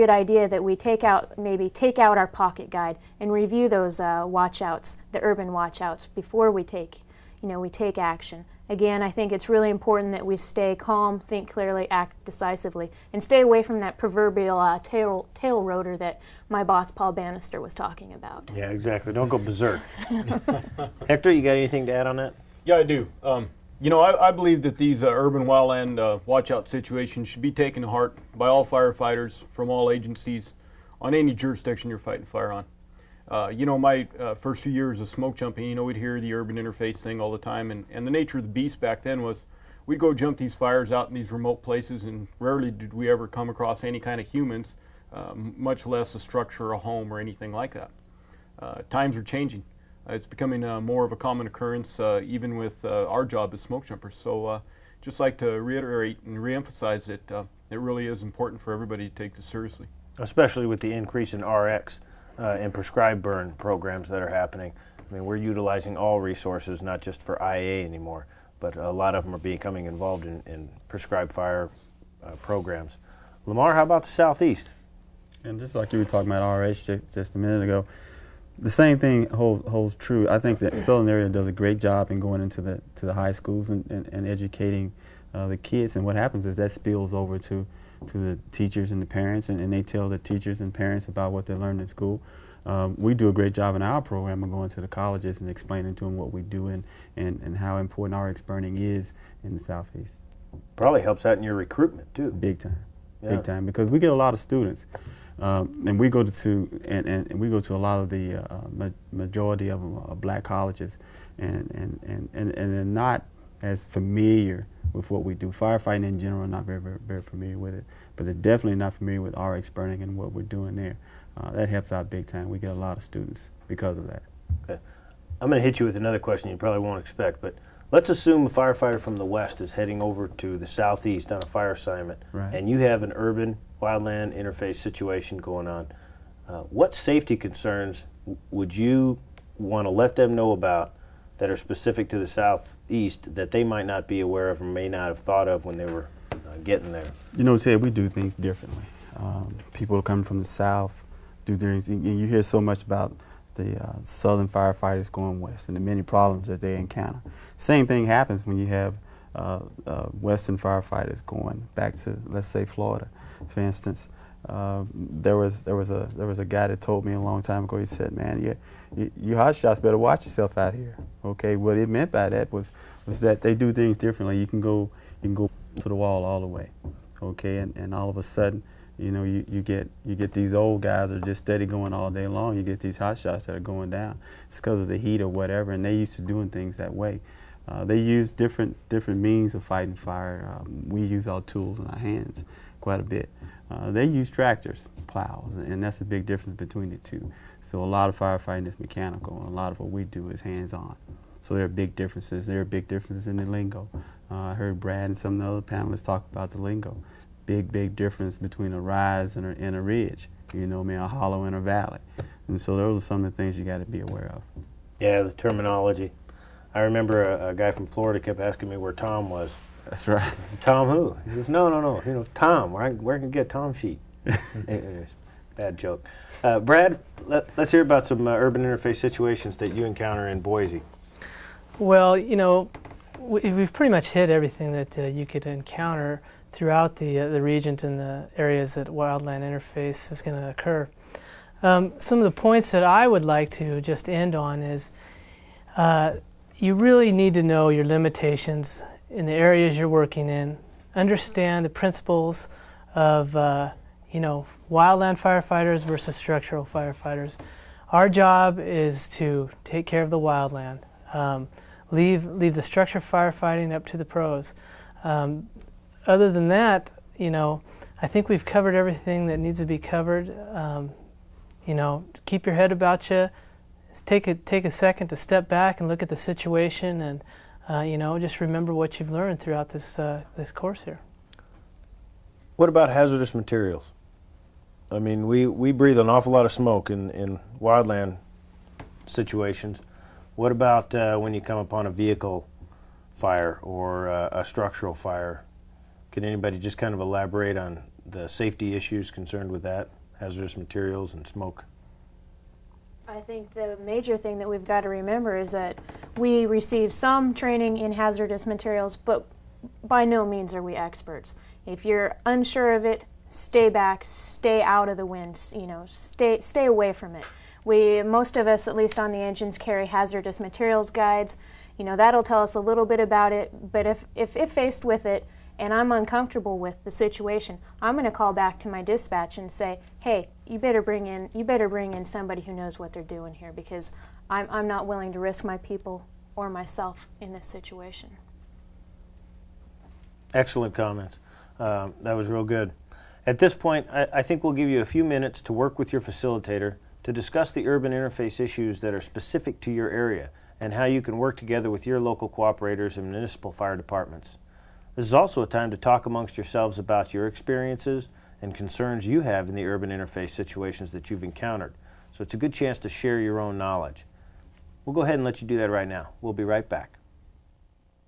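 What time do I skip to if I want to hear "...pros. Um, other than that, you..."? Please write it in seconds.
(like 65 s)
264 s.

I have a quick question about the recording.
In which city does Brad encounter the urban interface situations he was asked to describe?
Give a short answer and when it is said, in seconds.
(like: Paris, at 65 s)
Boise, at 230 s.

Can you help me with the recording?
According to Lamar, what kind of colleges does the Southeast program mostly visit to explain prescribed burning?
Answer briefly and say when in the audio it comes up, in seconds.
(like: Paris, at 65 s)
Black colleges, at 110 s.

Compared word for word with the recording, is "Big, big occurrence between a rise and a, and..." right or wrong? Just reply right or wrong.
wrong.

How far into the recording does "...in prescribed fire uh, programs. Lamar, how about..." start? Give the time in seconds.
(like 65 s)
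70 s.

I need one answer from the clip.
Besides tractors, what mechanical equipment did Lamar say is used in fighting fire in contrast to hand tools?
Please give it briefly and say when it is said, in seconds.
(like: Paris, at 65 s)
Plows, at 195 s.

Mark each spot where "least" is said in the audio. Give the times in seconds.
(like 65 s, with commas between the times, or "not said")
318 s.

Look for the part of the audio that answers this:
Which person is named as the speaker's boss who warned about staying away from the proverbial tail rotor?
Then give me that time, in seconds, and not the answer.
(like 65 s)
16 s.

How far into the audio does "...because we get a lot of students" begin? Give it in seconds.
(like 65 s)
103 s.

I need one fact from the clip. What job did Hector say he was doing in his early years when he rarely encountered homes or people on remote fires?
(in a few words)
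Smoke jumping.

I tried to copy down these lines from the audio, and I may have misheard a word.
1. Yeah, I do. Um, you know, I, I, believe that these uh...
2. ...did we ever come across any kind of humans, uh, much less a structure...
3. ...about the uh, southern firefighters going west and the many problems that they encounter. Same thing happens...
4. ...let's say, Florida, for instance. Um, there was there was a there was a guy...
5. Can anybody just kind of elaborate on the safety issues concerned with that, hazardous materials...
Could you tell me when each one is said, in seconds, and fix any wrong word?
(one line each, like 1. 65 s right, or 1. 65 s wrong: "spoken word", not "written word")
1. 22 s right
2. 42 s right
3. 152 s right
4. 162 s right
5. 296 s right.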